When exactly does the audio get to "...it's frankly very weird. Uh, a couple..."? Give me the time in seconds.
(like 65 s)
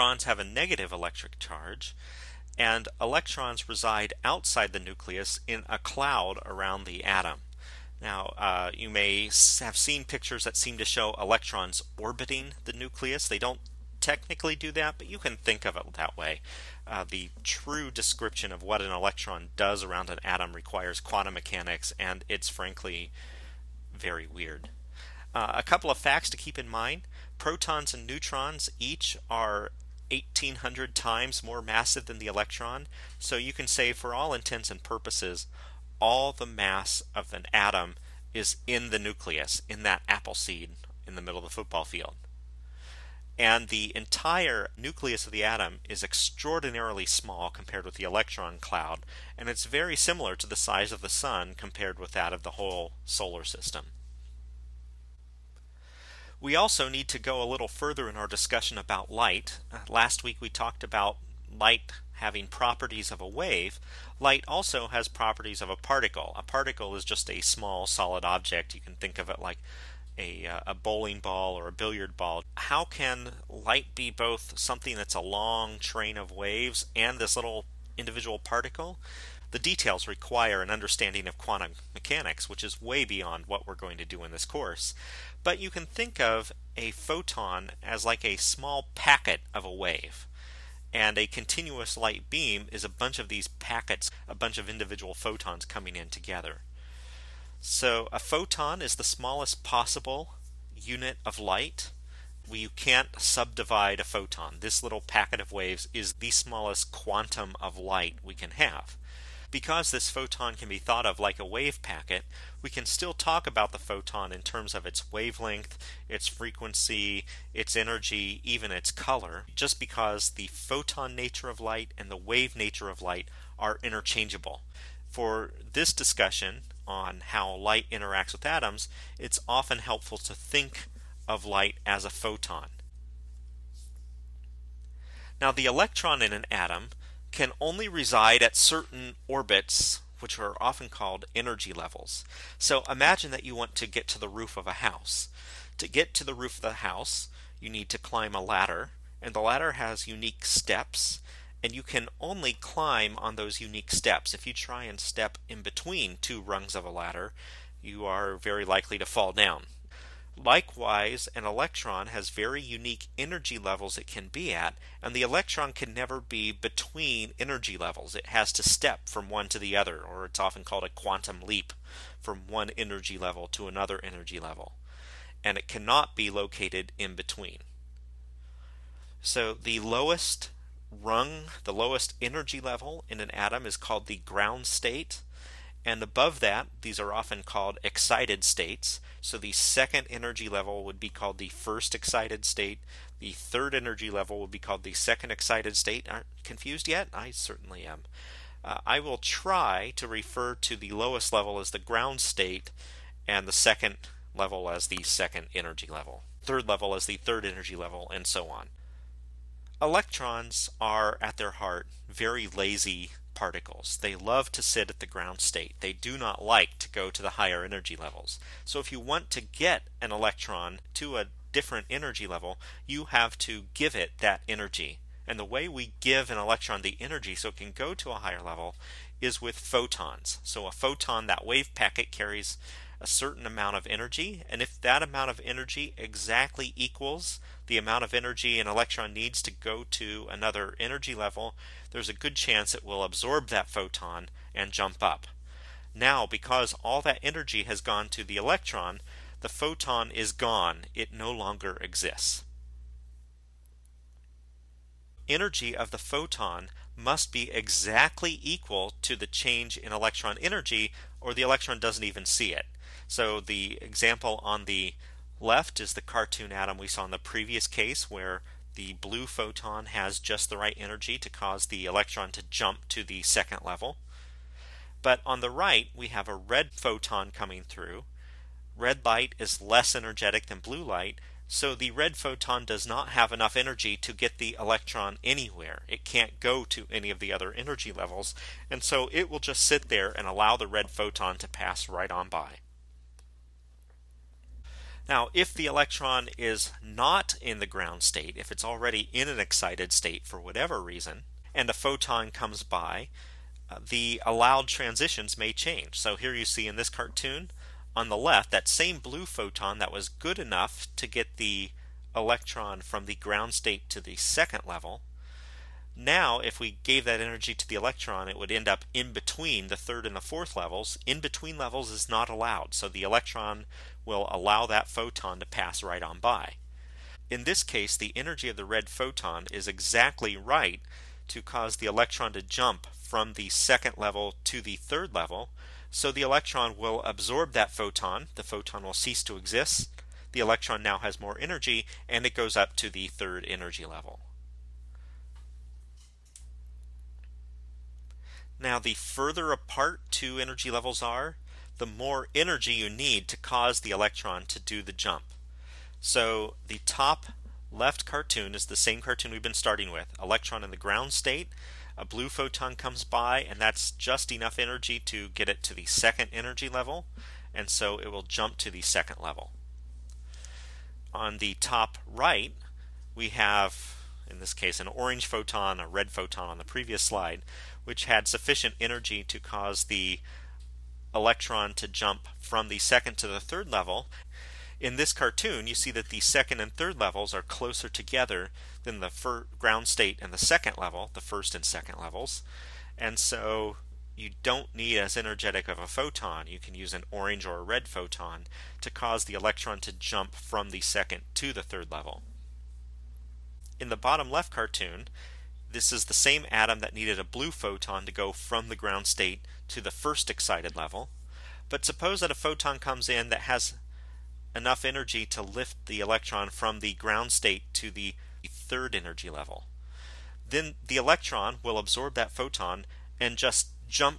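22 s.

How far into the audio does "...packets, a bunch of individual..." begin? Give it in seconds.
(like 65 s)
93 s.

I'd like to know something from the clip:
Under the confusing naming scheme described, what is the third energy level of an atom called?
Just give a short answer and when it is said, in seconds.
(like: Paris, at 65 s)
second excited state, at 194 s.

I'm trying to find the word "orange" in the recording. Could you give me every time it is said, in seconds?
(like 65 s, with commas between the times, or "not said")
374 s, 397 s.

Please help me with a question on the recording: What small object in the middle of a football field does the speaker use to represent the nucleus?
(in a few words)
apple seed.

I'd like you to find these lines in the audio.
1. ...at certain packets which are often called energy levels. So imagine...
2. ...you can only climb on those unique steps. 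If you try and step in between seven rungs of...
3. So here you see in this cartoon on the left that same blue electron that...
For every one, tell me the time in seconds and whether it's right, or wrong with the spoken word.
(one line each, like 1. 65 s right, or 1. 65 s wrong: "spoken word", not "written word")
1. 138 s wrong: "orbits", not "packets"
2. 151 s wrong: "two", not "seven"
3. 305 s wrong: "photon", not "electron".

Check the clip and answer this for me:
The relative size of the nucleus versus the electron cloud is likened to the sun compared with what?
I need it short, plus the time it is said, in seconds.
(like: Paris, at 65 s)
the whole solar system, at 52 s.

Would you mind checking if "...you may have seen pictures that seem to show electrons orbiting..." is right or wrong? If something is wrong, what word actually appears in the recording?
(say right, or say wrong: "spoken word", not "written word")
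right.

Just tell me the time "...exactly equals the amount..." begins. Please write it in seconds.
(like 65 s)
235 s.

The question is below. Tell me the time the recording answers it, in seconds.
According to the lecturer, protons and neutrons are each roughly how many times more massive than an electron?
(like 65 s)
30 s.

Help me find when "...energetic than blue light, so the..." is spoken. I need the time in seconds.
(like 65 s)
279 s.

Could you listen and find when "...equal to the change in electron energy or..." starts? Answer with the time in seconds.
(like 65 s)
258 s.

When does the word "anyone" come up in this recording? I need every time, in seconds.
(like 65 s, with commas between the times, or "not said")
not said.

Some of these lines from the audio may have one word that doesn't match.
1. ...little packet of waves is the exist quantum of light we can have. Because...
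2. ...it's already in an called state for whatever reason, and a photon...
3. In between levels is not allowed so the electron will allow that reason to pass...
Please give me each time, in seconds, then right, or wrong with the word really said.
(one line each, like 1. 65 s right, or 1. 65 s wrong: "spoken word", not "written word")
1. 104 s wrong: "smallest", not "exist"
2. 298 s wrong: "excited", not "called"
3. 321 s wrong: "photon", not "reason".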